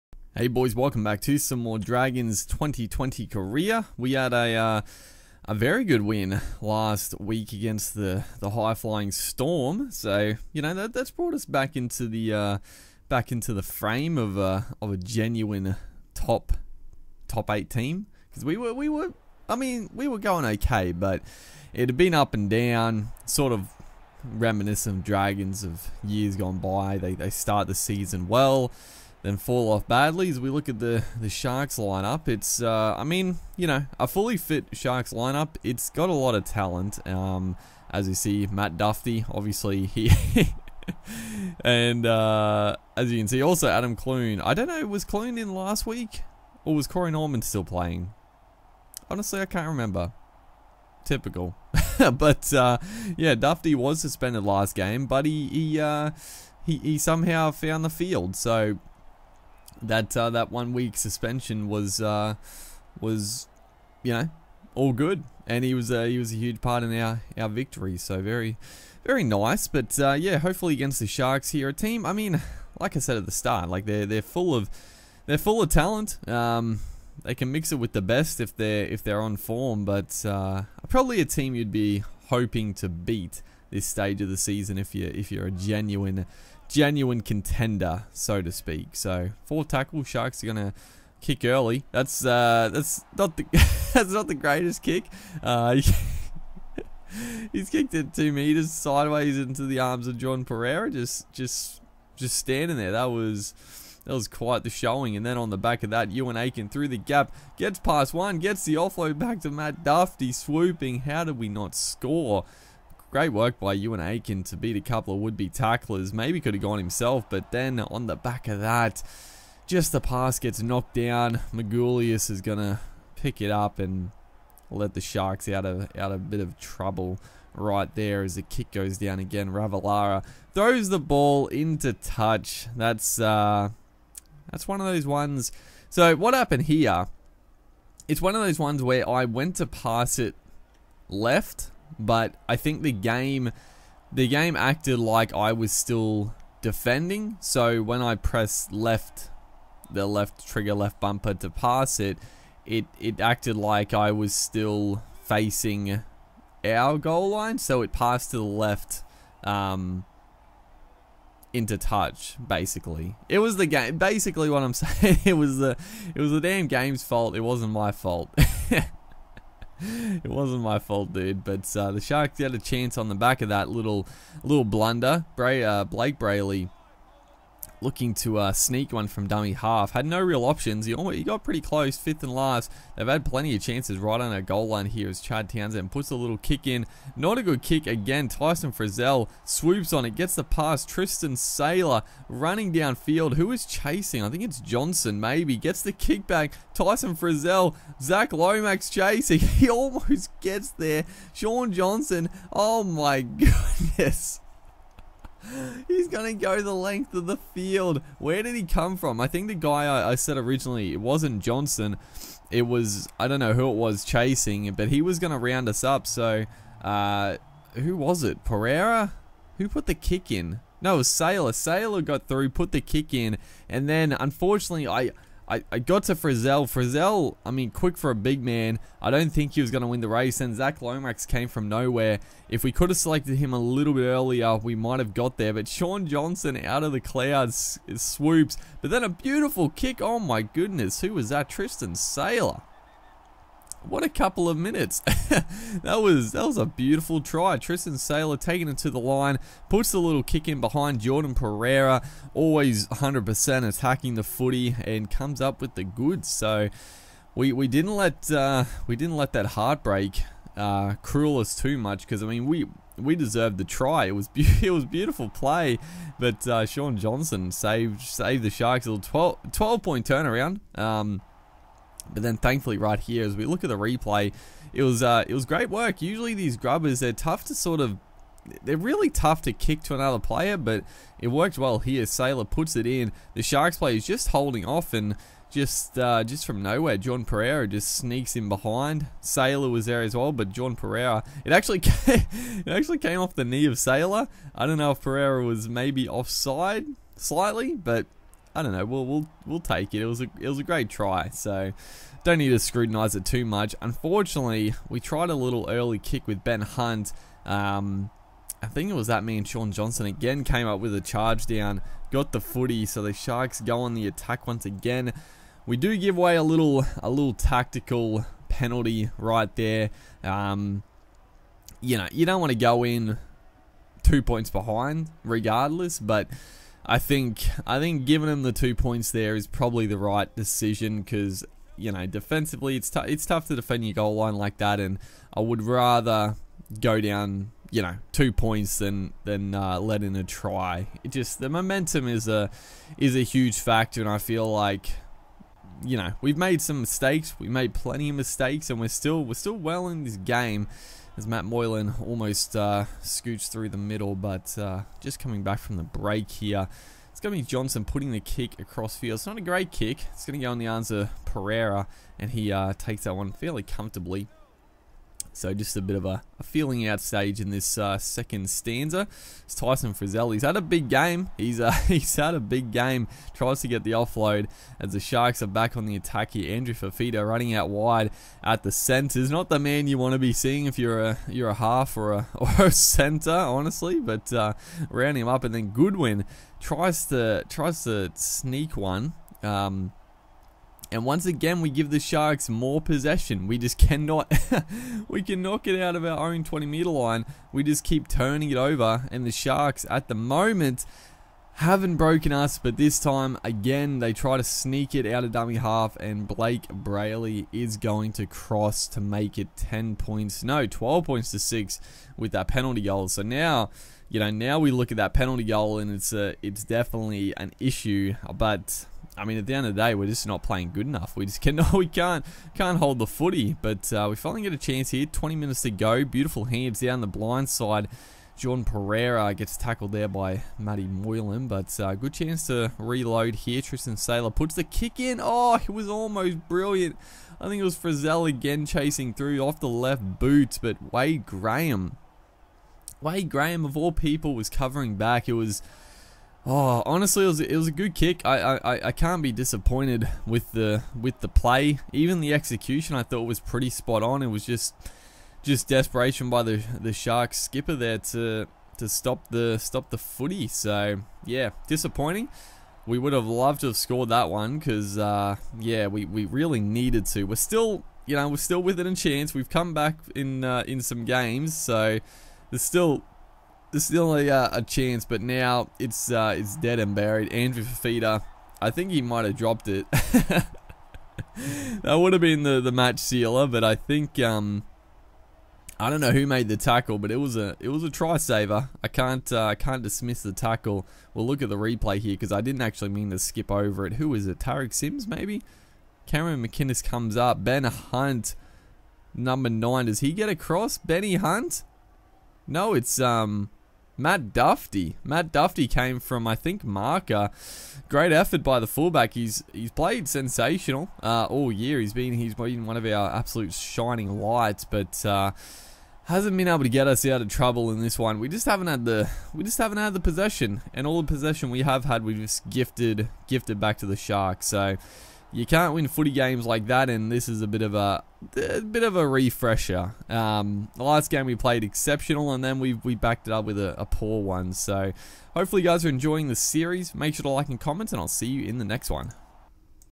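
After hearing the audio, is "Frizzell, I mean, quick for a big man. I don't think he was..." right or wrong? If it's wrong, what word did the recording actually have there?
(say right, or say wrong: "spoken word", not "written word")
right.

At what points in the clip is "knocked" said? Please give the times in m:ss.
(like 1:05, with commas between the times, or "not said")
2:00.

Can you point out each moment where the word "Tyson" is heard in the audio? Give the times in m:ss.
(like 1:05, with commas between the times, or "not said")
3:08, 3:16, 6:09.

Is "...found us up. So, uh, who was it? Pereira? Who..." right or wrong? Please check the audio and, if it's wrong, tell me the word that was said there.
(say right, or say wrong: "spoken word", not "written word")
wrong: "round", not "found".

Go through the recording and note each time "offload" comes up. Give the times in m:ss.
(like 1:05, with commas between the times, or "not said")
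1:48, 6:13.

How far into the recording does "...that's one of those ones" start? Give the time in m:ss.
2:14.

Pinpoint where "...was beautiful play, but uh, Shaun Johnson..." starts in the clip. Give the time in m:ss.
4:24.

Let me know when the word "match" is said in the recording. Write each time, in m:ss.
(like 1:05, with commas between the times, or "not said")
8:02.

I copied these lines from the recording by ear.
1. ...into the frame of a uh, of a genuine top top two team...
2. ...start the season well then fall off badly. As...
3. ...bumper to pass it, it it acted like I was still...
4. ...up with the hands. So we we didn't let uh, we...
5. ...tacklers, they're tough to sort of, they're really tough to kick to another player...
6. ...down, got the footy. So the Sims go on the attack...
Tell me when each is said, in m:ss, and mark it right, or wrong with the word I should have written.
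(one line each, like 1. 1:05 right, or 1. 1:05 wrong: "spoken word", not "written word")
1. 0:13 wrong: "eight", not "two"
2. 0:27 right
3. 2:30 right
4. 4:15 wrong: "goods", not "hands"
5. 4:36 wrong: "grubbers", not "tacklers"
6. 5:11 wrong: "Sharks", not "Sims".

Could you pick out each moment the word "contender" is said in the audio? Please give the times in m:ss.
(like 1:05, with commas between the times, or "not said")
1:27.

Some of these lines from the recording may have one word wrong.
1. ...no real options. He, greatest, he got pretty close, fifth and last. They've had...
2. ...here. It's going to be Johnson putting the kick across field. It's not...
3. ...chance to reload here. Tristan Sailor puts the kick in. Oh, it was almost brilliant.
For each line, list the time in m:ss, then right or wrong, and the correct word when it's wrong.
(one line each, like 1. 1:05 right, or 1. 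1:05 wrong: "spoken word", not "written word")
1. 3:00 wrong: "almost", not "greatest"
2. 5:56 right
3. 7:12 right.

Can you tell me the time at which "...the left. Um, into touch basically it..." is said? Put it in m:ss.
2:38.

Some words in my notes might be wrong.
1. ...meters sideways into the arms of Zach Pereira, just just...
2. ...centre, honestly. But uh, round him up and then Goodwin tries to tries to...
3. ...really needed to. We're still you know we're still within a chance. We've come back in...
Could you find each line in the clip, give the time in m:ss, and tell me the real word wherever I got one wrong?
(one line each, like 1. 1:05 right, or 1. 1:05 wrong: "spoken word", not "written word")
1. 1:38 wrong: "John", not "Zach"
2. 6:22 right
3. 7:46 right.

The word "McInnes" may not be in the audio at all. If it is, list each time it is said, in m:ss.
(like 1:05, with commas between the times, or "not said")
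8:16.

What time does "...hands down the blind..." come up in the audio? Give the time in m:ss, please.
7:06.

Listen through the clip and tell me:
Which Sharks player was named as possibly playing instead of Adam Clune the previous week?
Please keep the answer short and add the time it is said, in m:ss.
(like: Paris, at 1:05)
Corey Norman, at 0:46.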